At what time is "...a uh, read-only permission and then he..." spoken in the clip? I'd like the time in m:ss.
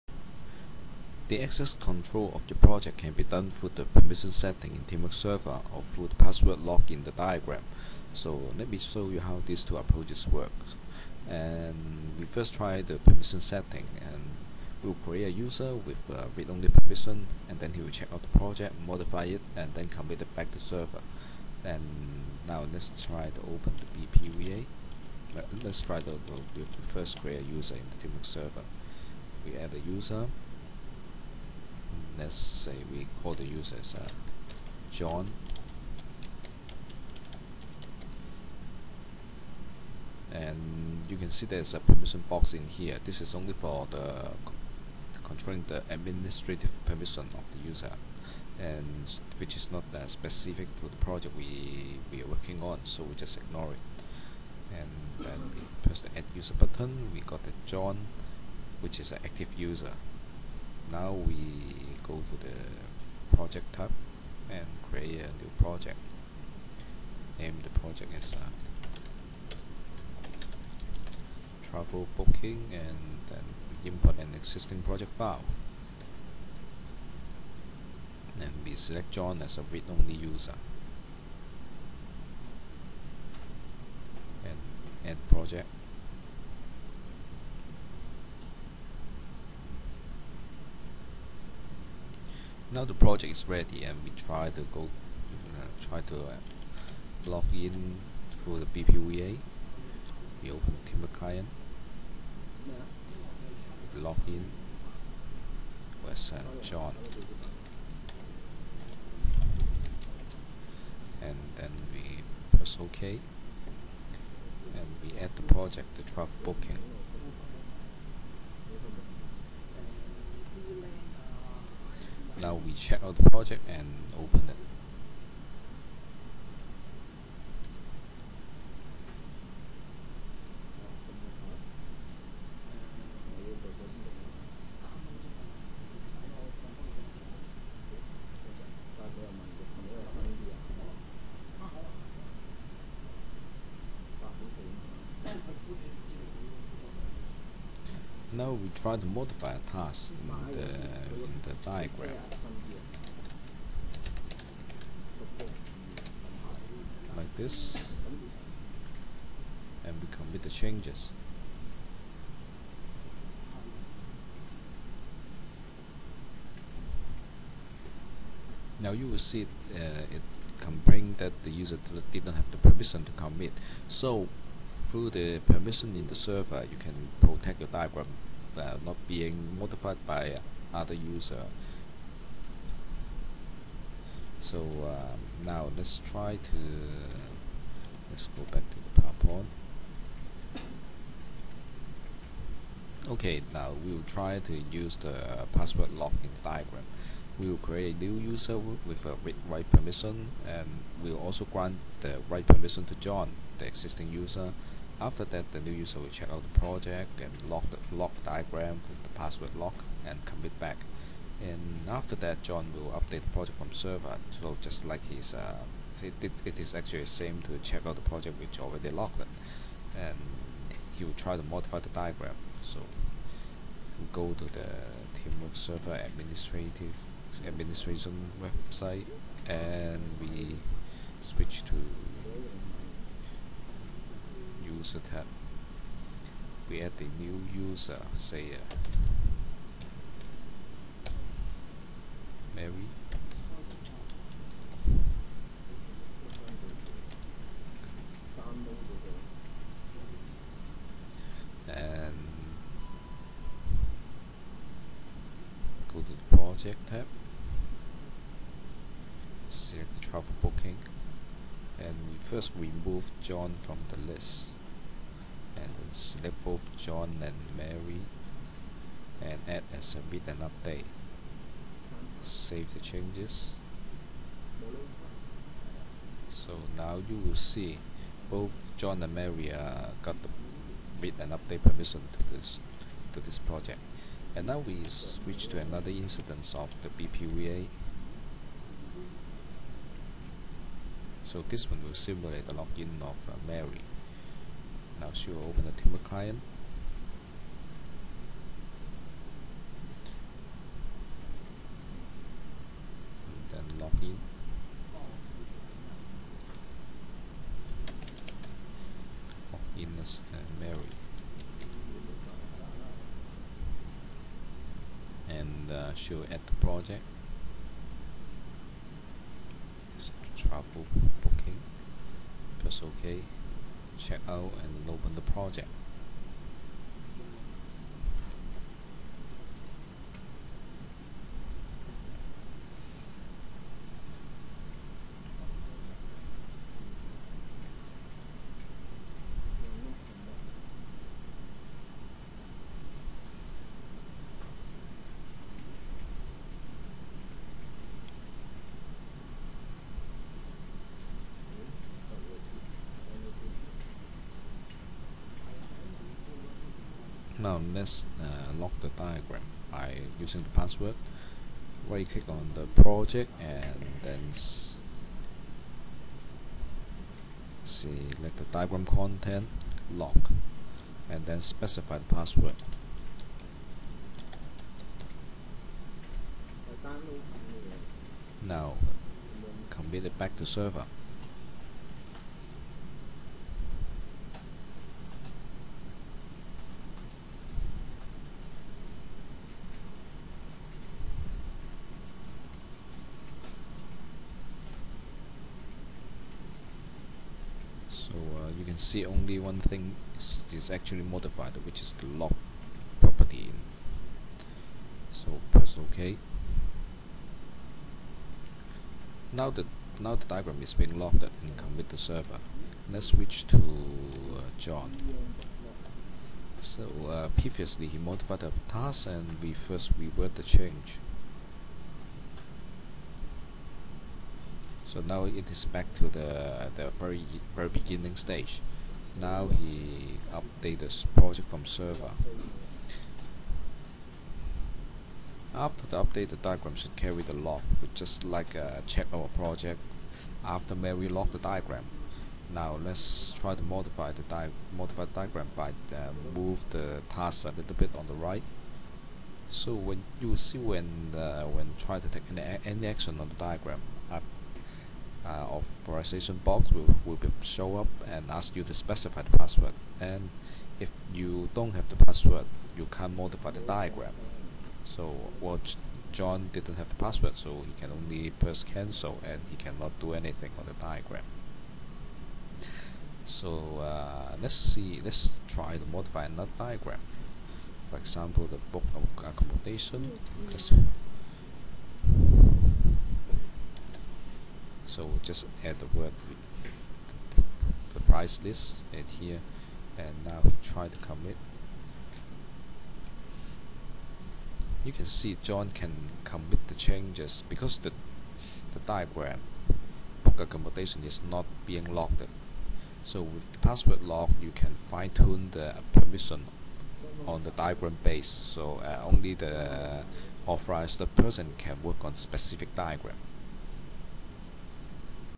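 0:16.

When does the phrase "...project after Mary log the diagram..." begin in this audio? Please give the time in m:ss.
7:19.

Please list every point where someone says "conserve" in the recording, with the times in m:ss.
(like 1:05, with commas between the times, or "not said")
not said.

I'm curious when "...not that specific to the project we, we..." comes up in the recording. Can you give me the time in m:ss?
0:49.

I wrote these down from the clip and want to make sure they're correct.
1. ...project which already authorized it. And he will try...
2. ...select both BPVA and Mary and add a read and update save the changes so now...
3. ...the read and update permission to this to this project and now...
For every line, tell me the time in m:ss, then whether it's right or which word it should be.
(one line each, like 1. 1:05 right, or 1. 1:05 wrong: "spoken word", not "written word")
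1. 3:38 wrong: "locked", not "authorized"
2. 4:25 wrong: "John", not "BPVA"
3. 4:40 right.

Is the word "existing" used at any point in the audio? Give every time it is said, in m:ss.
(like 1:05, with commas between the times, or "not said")
1:14, 3:23.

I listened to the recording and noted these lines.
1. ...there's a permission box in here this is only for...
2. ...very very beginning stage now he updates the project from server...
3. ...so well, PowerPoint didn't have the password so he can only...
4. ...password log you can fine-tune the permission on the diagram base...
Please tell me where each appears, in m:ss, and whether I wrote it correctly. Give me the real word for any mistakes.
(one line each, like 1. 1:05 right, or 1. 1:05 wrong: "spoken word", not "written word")
1. 0:41 right
2. 7:06 right
3. 7:44 wrong: "John", not "PowerPoint"
4. 8:23 right.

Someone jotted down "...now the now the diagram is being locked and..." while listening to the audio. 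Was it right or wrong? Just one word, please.
right.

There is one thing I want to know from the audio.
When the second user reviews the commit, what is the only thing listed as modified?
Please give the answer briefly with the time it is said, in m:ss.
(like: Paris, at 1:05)
the lock property, at 6:41.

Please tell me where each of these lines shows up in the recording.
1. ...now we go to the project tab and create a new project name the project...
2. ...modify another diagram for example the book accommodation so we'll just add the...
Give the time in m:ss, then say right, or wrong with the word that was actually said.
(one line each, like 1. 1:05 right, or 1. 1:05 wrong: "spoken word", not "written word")
1. 1:00 right
2. 7:55 right.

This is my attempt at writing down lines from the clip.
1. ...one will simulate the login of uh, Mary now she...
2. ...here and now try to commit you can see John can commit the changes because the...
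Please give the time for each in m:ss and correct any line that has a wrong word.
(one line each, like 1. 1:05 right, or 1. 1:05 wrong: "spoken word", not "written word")
1. 4:51 right
2. 8:09 right.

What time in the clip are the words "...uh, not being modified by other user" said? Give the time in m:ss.
2:58.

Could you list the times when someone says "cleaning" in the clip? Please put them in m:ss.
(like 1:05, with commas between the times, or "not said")
not said.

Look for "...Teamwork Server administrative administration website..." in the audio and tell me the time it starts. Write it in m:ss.
3:45.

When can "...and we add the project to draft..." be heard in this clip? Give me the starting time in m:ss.
1:54.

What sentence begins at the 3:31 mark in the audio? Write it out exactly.
And after that, John will update the project from server.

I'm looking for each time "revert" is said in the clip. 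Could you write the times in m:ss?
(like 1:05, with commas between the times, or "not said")
6:59.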